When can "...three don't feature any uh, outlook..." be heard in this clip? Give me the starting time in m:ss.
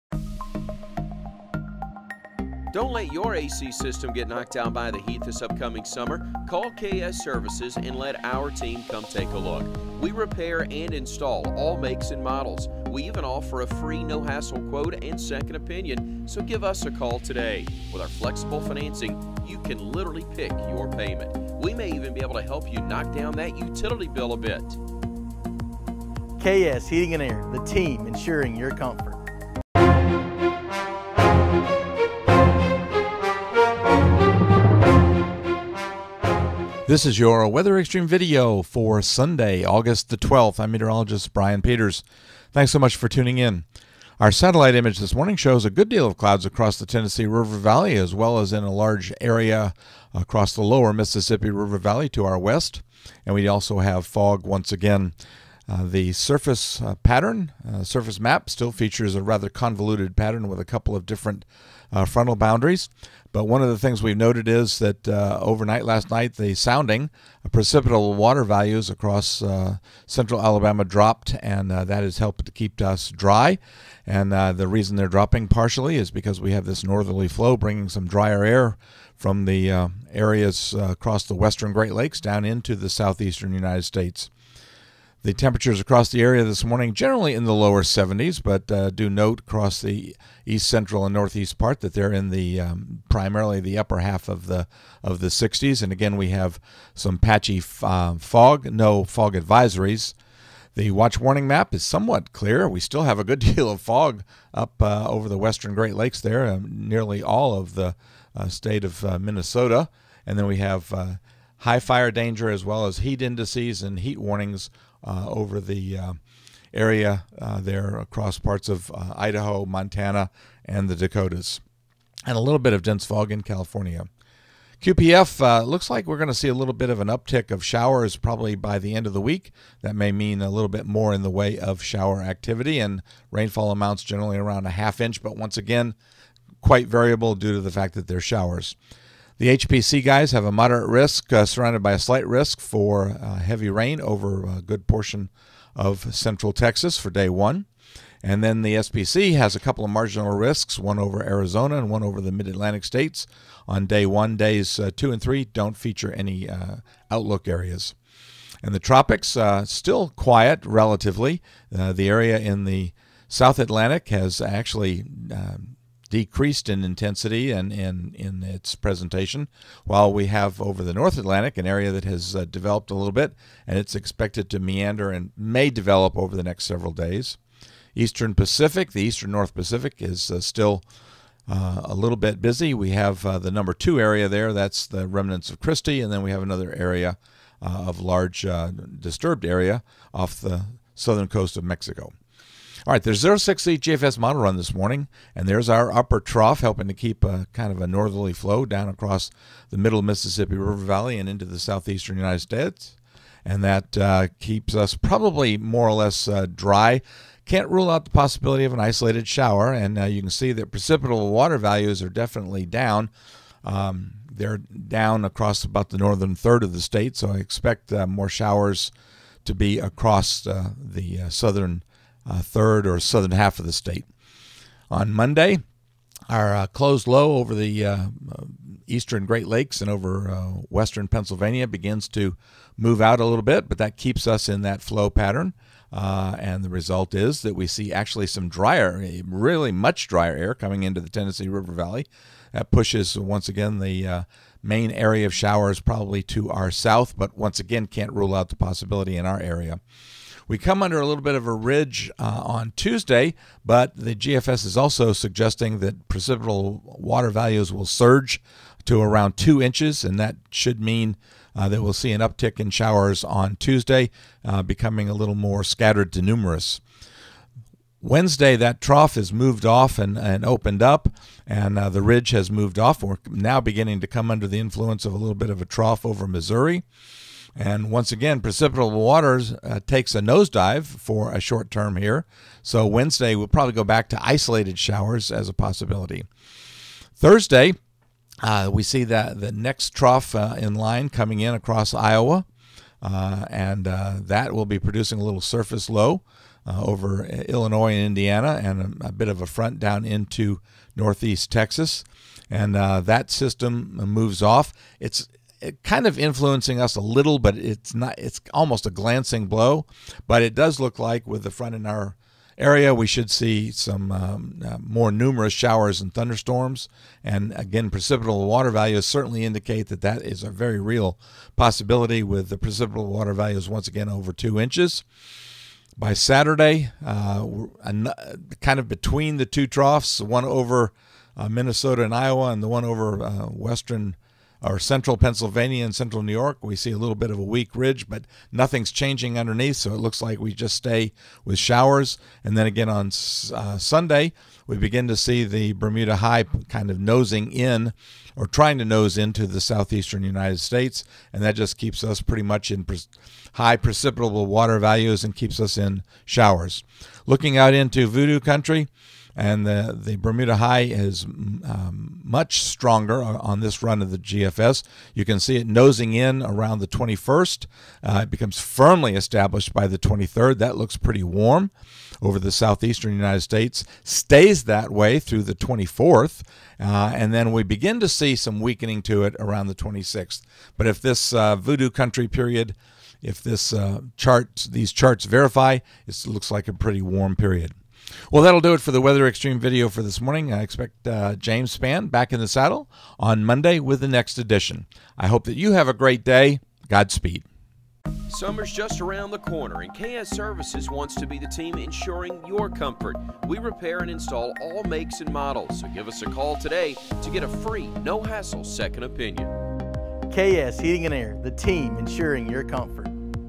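2:35.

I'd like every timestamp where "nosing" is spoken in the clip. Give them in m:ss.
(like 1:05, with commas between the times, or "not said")
5:46, 6:05.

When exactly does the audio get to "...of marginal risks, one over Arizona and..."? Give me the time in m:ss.
2:29.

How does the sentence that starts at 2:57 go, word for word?
Eastern Pacific, the Eastern North Pacific is uh, still uh, a little bit busy.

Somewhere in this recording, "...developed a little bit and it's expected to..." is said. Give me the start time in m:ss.
2:52.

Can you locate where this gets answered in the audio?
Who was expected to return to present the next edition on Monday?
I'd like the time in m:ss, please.
6:31.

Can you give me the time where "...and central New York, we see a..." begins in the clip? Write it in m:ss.
5:35.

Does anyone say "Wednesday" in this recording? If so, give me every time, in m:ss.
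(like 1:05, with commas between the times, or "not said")
4:28, 4:42.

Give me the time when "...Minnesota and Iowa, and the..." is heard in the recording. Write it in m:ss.
5:31.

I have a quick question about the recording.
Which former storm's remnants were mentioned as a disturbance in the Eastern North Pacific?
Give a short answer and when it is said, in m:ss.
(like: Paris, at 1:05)
Kristy, at 3:05.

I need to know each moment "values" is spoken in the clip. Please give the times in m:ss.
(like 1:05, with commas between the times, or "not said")
1:08, 3:31, 4:17, 5:18, 5:23, 5:54.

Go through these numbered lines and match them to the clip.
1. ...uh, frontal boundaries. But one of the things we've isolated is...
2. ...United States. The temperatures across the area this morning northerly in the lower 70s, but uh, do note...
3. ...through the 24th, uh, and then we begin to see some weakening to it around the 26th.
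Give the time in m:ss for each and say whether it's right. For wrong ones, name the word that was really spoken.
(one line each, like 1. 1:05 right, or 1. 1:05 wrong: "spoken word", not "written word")
1. 1:01 wrong: "noted", not "isolated"
2. 1:23 wrong: "generally", not "northerly"
3. 6:15 right.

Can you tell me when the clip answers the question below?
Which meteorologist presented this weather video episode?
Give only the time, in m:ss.
0:41.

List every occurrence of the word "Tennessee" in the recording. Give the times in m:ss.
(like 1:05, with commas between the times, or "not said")
0:46, 4:01.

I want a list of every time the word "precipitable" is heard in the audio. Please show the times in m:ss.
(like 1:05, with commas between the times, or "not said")
1:07, 3:30, 4:16, 4:38, 5:17, 5:22, 5:53.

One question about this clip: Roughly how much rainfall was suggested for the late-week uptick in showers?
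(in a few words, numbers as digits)
half inch.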